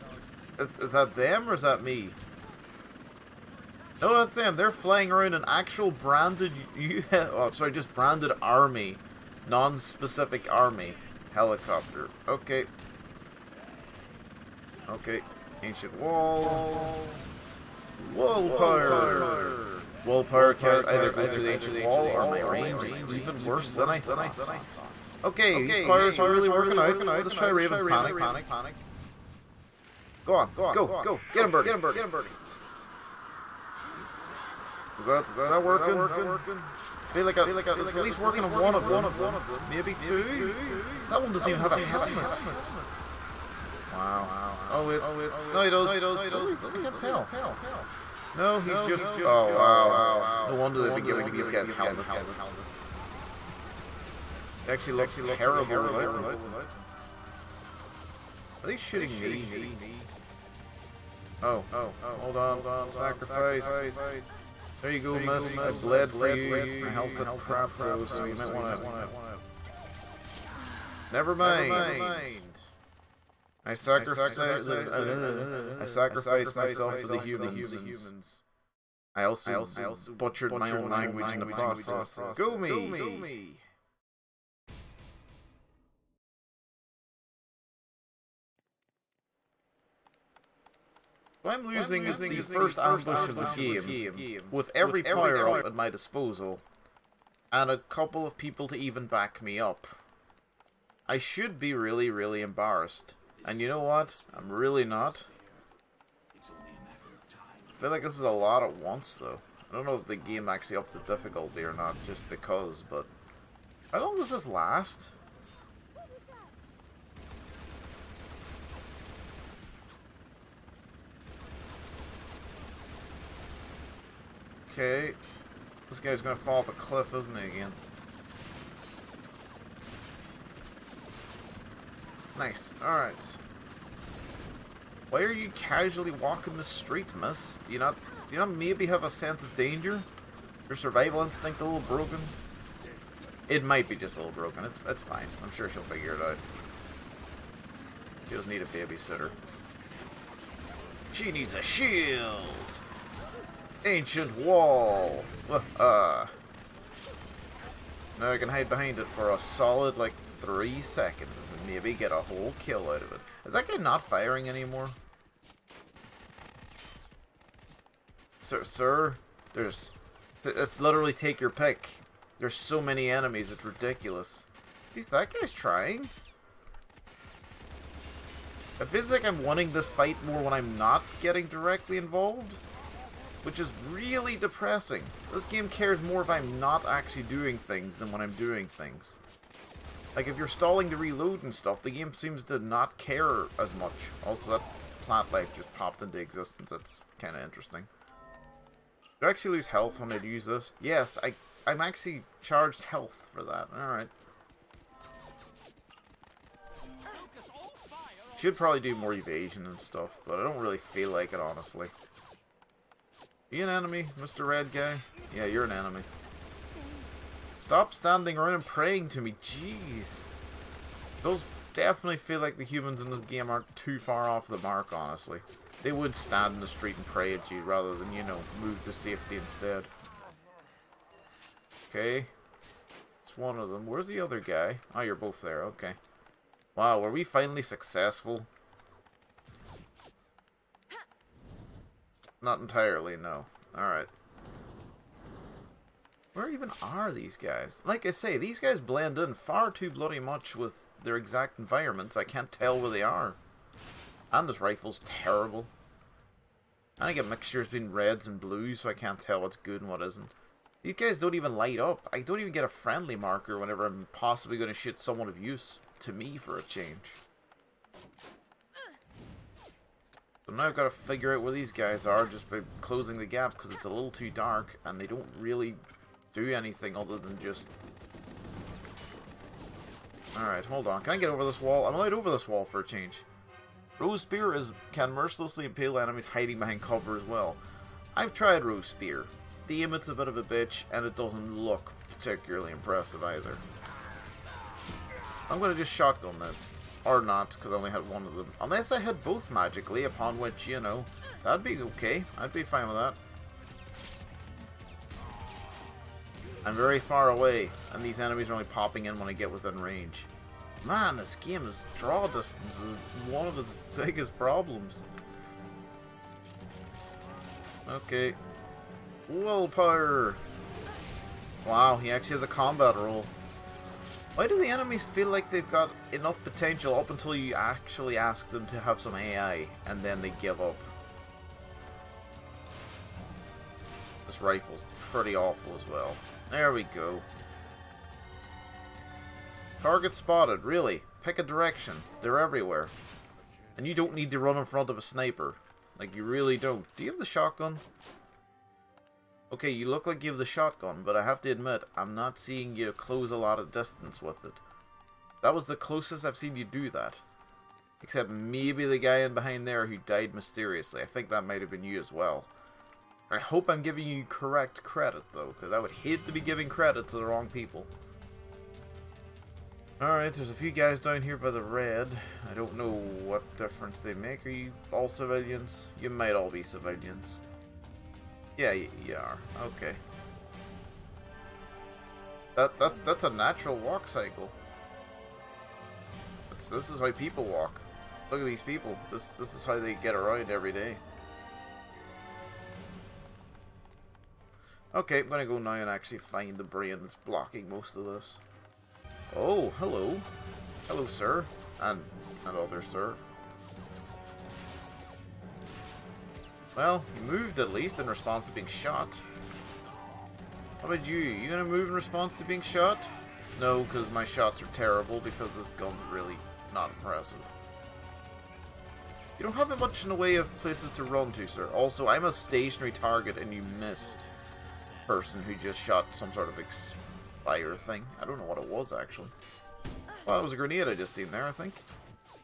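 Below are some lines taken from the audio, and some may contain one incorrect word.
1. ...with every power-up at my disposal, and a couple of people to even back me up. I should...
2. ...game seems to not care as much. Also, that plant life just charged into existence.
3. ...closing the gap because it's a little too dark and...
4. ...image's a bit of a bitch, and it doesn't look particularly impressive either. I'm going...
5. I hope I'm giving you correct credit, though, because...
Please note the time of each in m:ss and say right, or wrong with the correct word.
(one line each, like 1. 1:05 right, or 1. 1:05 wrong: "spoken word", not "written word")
1. 1:34 right
2. 3:11 wrong: "popped", not "charged"
3. 4:32 right
4. 4:49 right
5. 6:03 right.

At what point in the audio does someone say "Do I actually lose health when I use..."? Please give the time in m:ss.
3:19.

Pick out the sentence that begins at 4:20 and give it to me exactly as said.
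These guys don't even light up.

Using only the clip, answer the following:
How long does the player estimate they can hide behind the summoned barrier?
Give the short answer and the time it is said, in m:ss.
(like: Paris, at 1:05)
three seconds, at 2:40.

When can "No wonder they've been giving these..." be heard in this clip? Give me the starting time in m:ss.
0:50.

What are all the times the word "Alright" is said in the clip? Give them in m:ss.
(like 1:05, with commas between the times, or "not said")
2:12, 3:23, 4:03, 4:40, 6:10.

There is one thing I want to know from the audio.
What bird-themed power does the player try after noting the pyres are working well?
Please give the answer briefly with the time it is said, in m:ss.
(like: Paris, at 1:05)
Raven's Panic, at 0:27.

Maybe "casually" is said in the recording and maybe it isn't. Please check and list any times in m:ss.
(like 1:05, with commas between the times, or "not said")
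2:15.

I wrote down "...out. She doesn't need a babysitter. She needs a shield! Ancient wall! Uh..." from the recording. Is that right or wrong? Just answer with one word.
right.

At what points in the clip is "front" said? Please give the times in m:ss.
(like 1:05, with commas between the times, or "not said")
5:44.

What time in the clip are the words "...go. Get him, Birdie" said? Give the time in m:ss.
0:30.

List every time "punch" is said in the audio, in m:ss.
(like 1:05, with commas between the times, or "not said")
not said.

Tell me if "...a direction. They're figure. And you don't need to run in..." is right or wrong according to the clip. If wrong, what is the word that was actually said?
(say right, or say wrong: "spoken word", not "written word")
wrong: "everywhere", not "figure".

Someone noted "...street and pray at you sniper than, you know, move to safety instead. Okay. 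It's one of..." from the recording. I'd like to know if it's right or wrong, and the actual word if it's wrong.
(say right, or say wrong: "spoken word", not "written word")
wrong: "rather", not "sniper".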